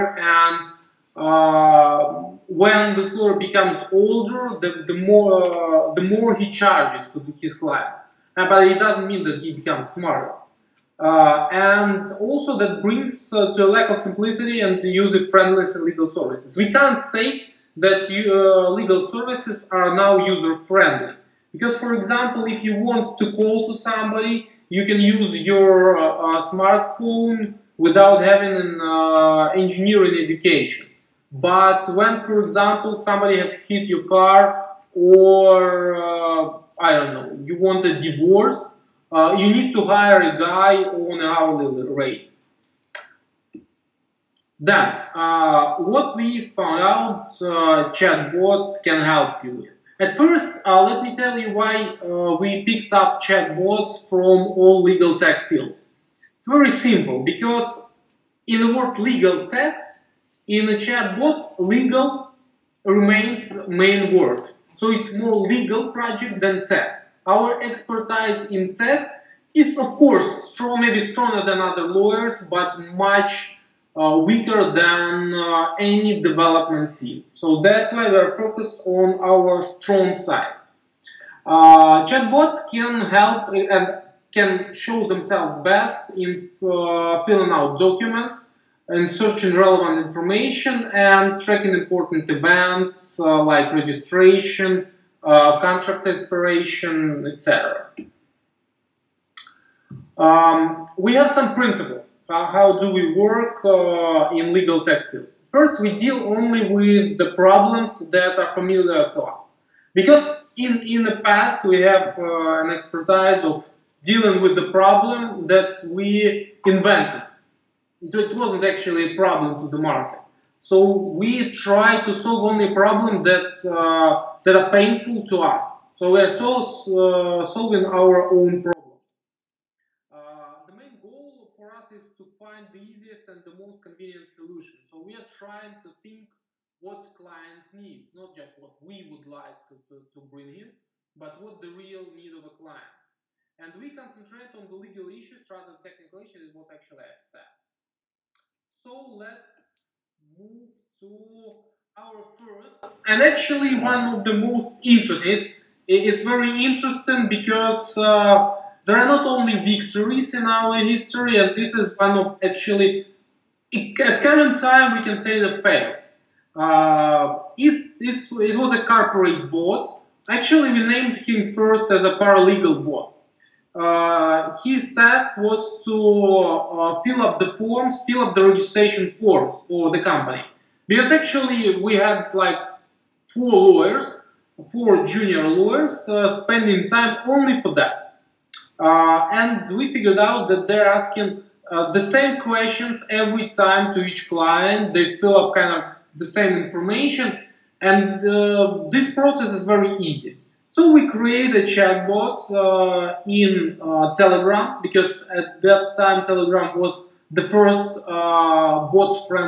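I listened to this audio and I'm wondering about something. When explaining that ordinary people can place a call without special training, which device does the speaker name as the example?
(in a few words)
smartphone.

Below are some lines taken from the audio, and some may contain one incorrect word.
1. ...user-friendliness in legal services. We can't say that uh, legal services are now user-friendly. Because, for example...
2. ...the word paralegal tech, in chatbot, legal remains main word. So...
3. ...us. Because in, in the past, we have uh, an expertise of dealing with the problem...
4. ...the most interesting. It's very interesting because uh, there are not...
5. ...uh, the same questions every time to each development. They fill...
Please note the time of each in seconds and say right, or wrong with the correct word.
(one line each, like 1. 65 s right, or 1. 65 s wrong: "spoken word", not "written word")
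1. 14 s right
2. 58 s wrong: "legal", not "paralegal"
3. 109 s right
4. 154 s right
5. 191 s wrong: "client", not "development".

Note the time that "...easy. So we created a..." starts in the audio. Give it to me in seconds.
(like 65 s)
199 s.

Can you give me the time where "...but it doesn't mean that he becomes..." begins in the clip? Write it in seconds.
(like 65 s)
8 s.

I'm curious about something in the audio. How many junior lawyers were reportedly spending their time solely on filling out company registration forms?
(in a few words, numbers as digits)
4.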